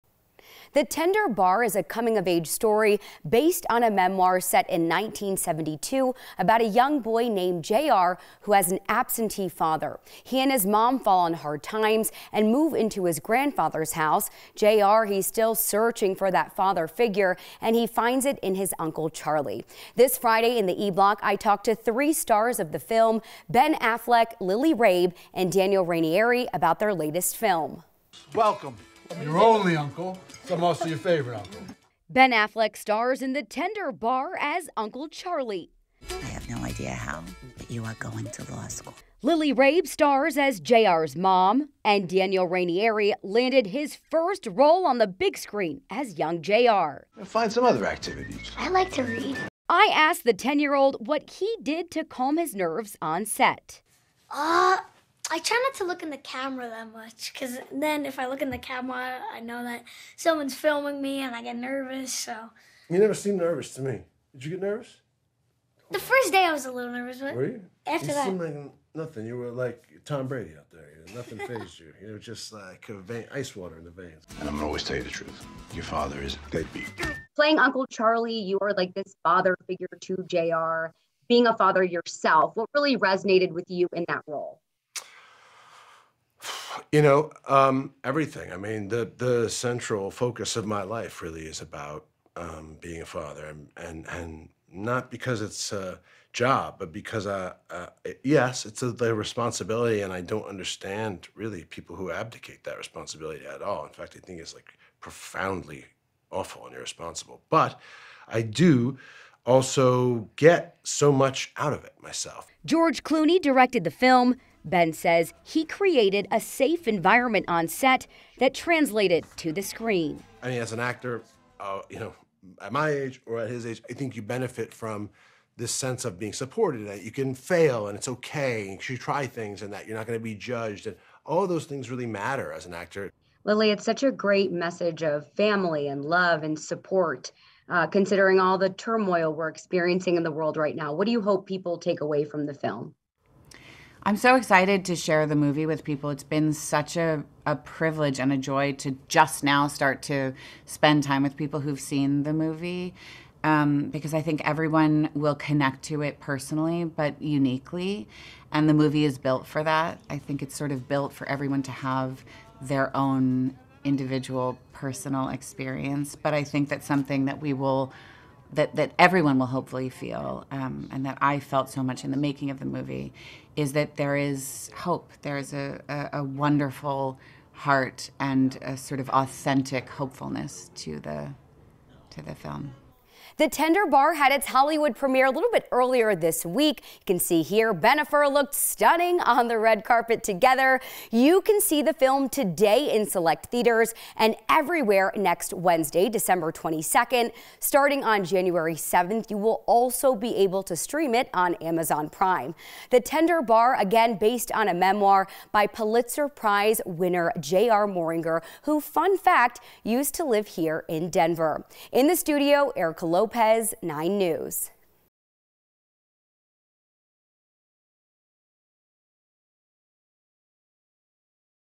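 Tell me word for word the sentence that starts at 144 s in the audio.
I'm so excited to share the movie with people.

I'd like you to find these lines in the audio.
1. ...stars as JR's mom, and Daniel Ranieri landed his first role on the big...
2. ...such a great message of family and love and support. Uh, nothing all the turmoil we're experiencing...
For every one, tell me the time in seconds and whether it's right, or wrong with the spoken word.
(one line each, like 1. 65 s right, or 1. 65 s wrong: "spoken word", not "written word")
1. 39 s right
2. 133 s wrong: "considering", not "nothing".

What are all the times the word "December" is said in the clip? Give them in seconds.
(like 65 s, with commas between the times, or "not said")
196 s.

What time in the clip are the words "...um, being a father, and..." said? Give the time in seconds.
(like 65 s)
92 s.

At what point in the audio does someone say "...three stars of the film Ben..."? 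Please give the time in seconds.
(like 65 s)
21 s.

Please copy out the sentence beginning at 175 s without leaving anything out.
There is a, a, a wonderful heart and a sort of authentic hopefulness to the to the film.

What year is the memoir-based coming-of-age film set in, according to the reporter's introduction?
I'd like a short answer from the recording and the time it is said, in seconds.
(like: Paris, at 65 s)
1972, at 4 s.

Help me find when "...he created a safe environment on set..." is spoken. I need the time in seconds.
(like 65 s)
115 s.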